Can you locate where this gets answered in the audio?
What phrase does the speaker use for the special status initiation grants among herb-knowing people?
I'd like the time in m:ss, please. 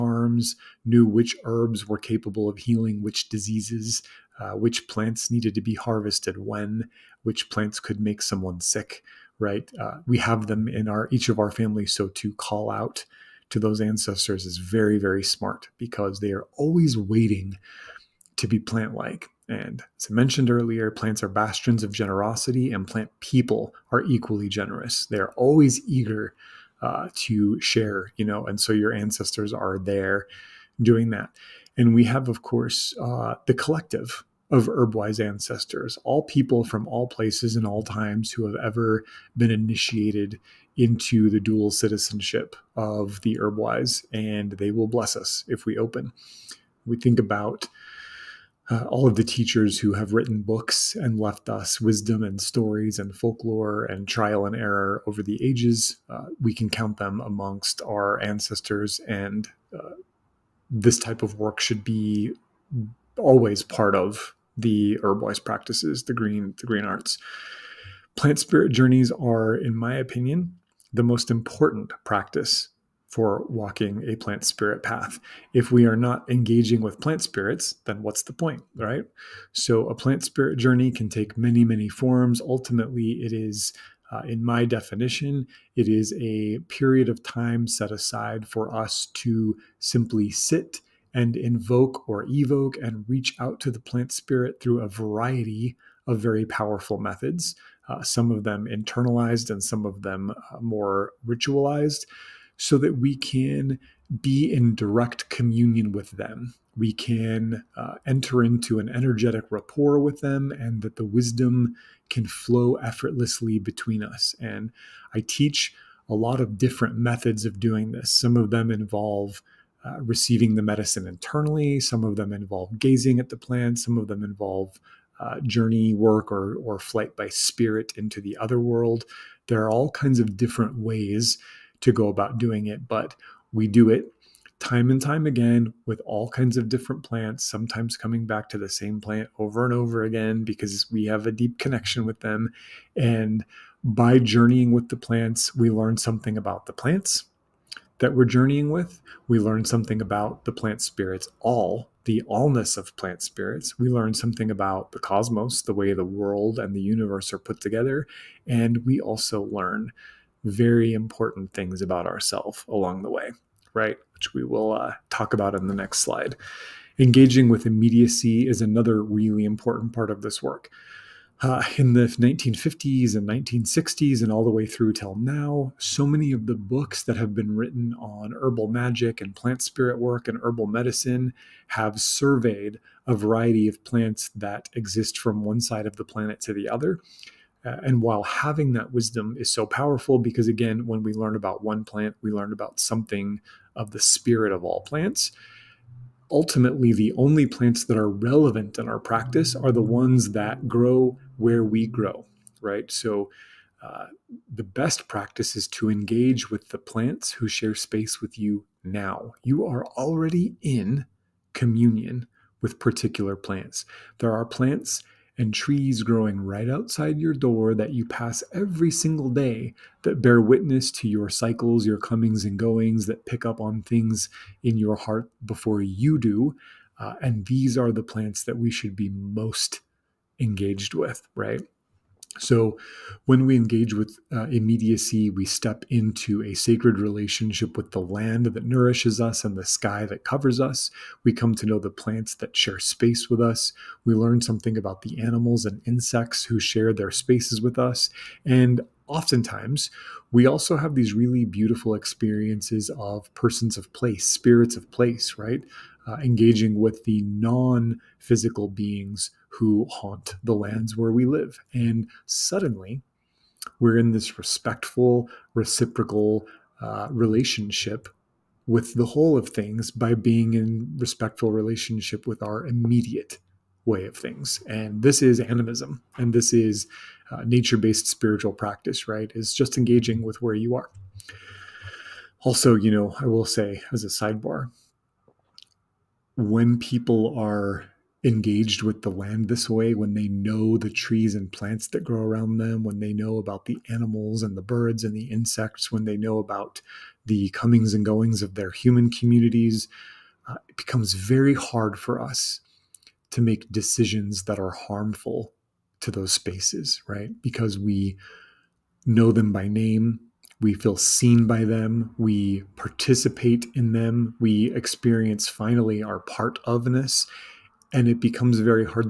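0:41.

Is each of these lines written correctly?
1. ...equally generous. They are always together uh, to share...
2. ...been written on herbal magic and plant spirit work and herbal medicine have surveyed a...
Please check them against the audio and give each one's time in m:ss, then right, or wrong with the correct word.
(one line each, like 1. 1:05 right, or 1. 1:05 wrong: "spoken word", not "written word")
1. 0:24 wrong: "eager", not "together"
2. 2:57 right.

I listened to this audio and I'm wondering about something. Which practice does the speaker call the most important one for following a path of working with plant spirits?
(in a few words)
Plant spirit journeys.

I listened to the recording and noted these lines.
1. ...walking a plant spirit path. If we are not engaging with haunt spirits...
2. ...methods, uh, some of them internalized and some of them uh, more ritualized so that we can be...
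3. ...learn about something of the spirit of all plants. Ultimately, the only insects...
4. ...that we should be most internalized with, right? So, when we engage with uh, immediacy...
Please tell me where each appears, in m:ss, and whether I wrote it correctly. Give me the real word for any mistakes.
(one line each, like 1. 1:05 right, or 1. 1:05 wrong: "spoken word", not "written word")
1. 1:13 wrong: "plant", not "haunt"
2. 1:36 right
3. 3:12 wrong: "plants", not "insects"
4. 3:48 wrong: "engaged", not "internalized".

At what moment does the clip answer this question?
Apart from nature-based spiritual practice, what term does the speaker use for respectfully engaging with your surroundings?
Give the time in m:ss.
4:35.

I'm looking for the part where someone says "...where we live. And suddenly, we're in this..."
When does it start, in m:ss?
4:20.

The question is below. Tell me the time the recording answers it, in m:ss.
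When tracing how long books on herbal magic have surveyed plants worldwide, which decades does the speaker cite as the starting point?
2:52.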